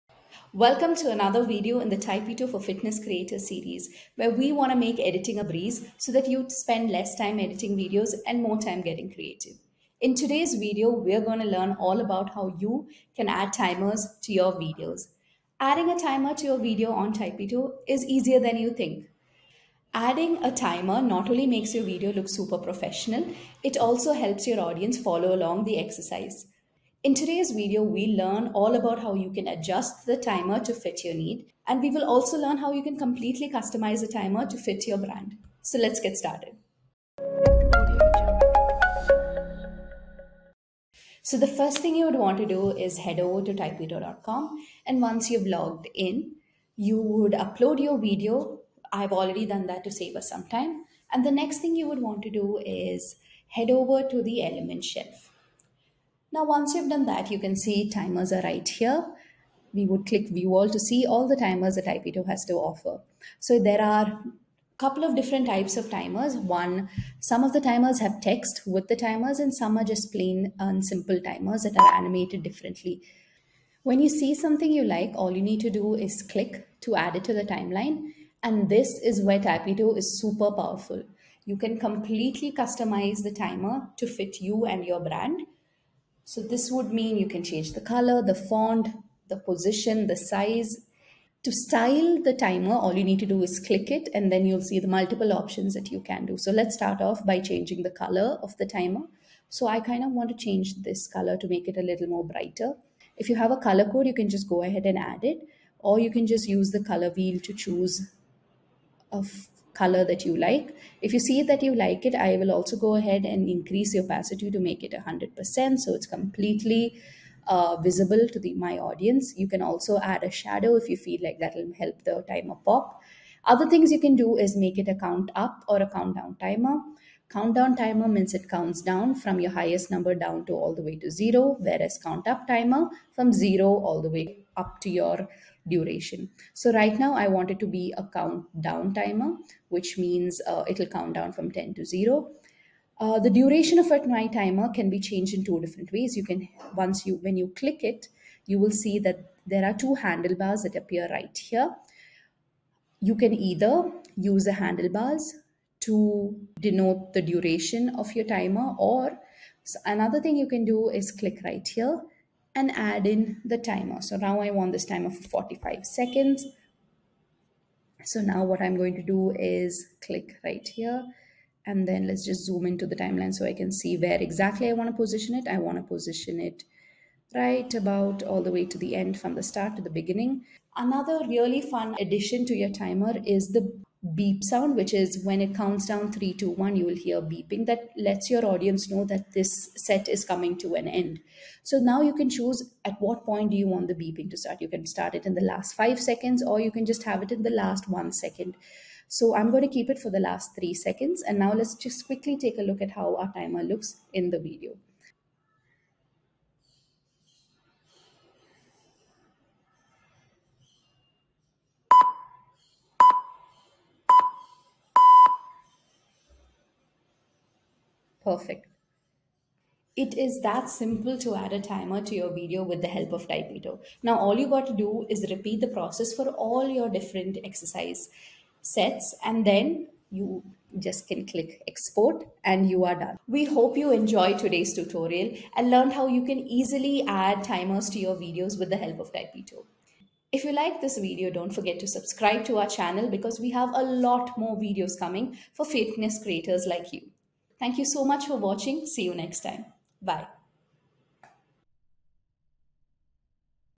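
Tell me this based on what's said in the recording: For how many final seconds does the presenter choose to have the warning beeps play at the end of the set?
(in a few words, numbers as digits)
3.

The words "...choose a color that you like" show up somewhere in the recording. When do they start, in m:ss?
1:47.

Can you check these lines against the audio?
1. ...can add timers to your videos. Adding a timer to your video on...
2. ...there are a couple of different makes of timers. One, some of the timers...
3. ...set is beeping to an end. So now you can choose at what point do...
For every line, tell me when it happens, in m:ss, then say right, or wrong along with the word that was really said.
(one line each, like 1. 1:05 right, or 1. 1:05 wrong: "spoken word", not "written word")
1. 0:13 right
2. 1:03 wrong: "types", not "makes"
3. 3:09 wrong: "coming", not "beeping".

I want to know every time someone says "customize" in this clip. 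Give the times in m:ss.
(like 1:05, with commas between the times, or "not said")
0:33, 1:22.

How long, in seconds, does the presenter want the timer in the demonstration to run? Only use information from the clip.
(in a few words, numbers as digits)
45 seconds.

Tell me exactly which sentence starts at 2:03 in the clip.
Other things you can do is make it a count up or a countdown timer.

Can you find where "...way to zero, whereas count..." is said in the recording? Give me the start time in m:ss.
2:10.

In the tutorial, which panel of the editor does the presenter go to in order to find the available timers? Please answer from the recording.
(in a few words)
Element shelf.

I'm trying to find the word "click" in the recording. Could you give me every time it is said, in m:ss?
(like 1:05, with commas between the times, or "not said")
1:00, 1:16, 1:33, 2:27, 2:41, 2:50, 3:51.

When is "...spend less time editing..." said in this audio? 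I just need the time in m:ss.
0:06.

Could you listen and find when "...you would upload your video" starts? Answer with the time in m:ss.
0:46.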